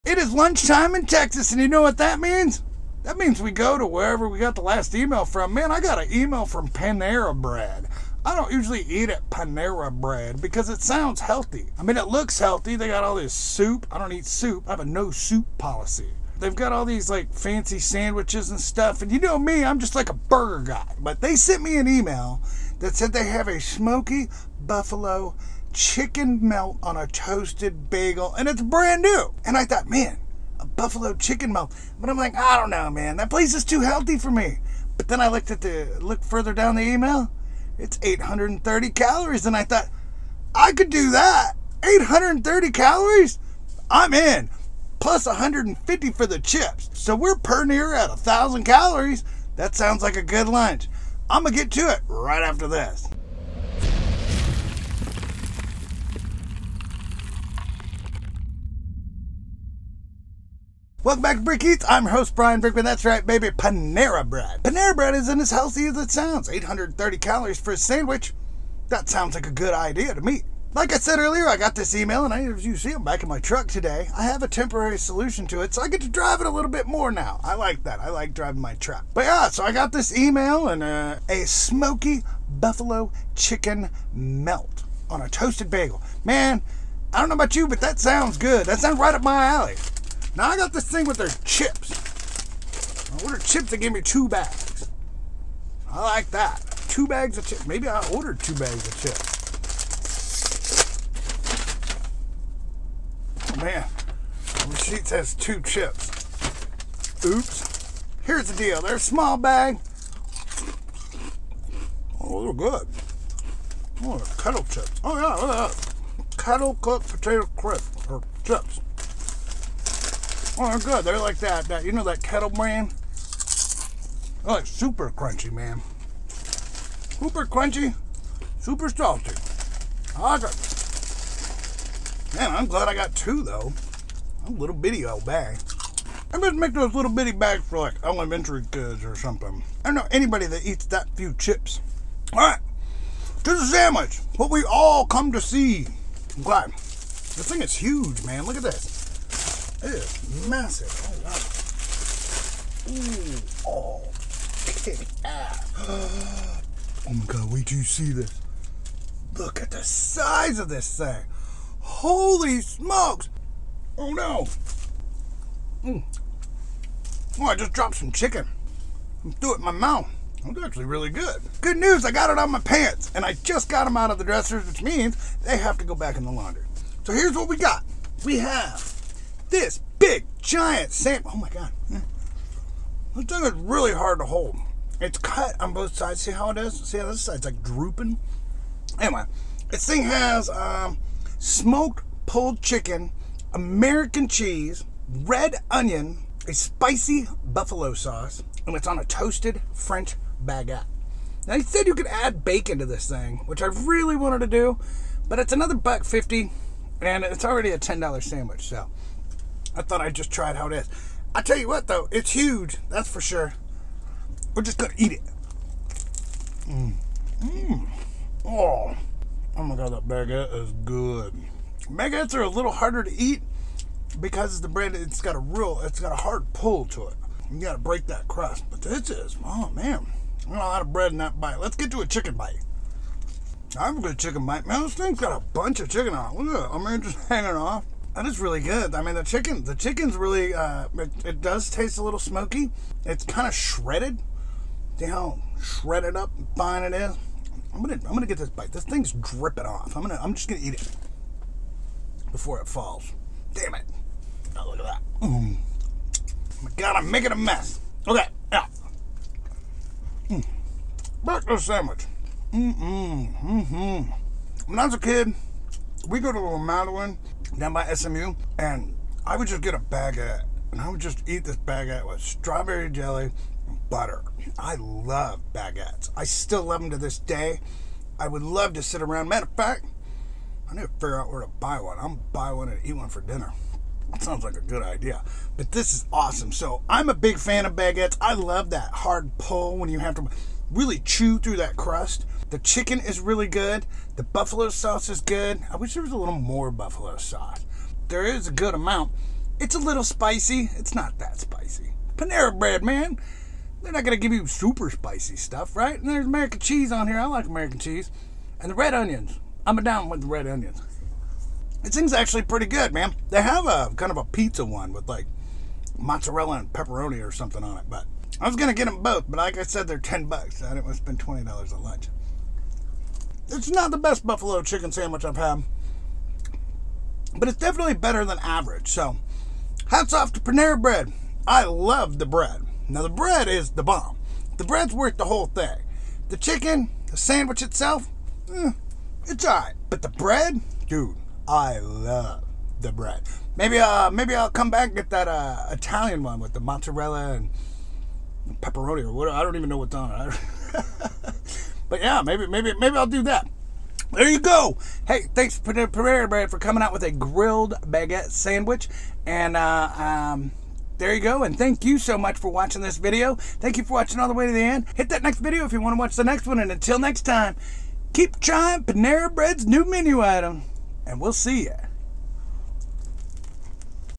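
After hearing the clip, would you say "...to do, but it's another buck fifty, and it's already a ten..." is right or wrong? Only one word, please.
right.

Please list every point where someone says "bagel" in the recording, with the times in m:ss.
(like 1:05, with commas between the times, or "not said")
0:27, 1:25.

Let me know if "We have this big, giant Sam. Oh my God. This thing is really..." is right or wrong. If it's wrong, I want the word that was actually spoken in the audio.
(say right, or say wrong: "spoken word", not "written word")
right.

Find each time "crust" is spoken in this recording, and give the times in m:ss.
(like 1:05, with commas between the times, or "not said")
3:48, 4:51.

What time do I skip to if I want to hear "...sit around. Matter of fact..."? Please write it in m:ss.
4:38.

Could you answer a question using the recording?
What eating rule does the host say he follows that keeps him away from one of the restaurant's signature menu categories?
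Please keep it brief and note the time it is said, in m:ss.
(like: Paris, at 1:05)
no soup policy, at 0:14.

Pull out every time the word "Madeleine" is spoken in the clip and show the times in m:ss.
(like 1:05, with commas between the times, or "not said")
4:26.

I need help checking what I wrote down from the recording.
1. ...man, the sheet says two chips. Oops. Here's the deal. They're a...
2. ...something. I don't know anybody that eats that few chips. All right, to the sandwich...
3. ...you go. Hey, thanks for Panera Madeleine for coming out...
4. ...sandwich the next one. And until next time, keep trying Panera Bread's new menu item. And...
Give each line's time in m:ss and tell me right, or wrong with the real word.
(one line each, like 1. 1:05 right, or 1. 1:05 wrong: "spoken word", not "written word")
1. 1:43 right
2. 2:19 right
3. 5:54 wrong: "Bread", not "Madeleine"
4. 6:05 wrong: "watch", not "sandwich".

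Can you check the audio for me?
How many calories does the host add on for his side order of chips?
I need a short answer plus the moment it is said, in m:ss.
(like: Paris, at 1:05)
150, at 0:45.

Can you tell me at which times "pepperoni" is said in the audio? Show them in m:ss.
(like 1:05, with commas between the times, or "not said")
5:16, 5:48.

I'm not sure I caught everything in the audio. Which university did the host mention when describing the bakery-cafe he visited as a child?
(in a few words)
SMU.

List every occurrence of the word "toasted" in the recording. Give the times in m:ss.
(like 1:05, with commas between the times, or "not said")
0:27, 1:25, 3:19.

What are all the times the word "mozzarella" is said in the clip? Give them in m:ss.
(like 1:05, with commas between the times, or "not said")
5:15, 5:46.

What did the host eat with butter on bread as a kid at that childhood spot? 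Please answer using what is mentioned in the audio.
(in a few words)
strawberry jelly.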